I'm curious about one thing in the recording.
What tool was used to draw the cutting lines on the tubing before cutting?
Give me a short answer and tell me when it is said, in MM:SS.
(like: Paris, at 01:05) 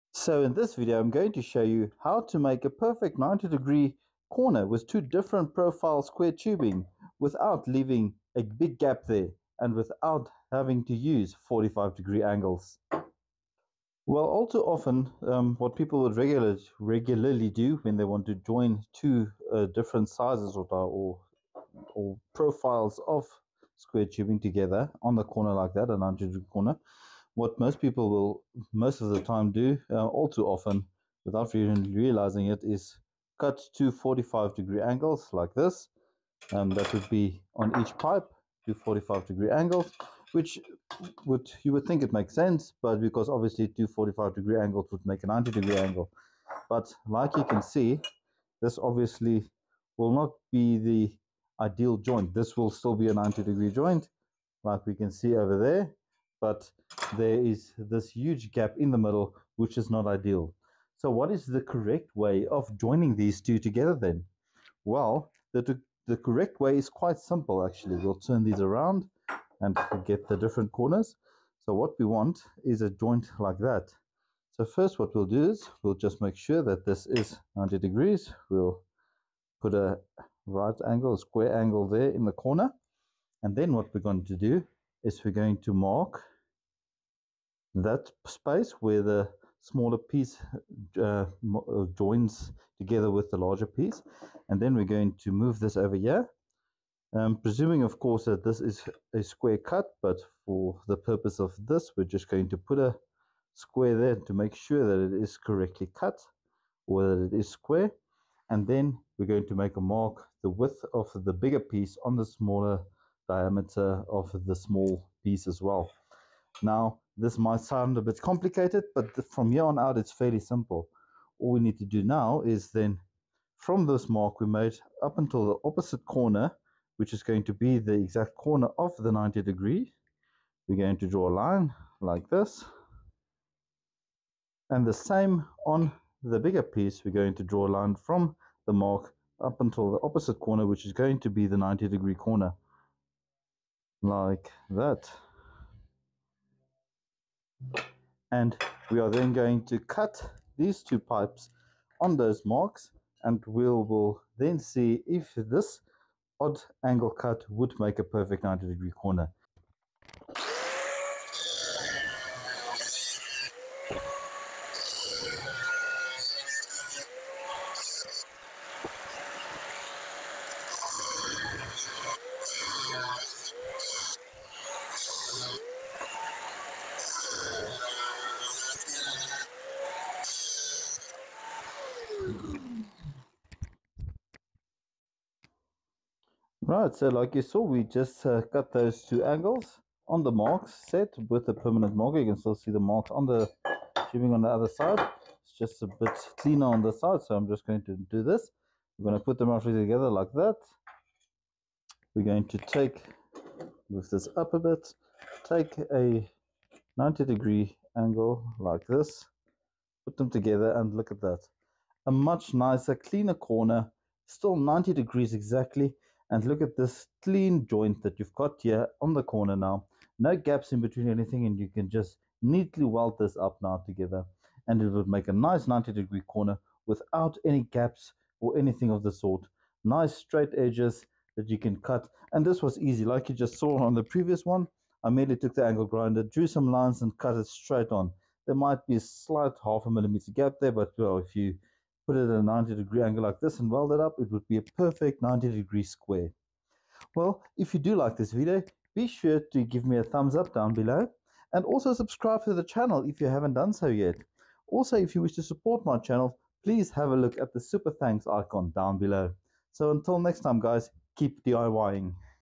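permanent marker, at 03:11.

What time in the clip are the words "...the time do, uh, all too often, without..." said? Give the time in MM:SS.
00:29.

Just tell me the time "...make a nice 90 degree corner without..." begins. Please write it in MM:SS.
03:45.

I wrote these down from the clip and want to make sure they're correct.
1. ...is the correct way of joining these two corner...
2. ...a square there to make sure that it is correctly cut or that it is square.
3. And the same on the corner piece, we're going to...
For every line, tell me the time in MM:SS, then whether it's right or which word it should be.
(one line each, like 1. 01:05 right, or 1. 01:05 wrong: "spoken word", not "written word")
1. 01:01 wrong: "together", not "corner"
2. 01:42 right
3. 02:14 wrong: "bigger", not "corner".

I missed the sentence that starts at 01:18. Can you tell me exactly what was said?
We'll put a right angle, a square angle there in the corner.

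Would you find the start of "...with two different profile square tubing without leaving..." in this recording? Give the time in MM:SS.
00:04.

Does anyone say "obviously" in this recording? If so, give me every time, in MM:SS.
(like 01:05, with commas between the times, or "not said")
00:43, 00:48.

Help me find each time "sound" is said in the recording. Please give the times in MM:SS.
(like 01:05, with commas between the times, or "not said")
01:57.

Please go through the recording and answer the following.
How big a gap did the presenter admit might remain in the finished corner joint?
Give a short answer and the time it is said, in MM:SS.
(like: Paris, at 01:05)
half a millimeter, at 03:59.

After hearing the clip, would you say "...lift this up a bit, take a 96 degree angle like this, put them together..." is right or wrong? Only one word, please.
wrong.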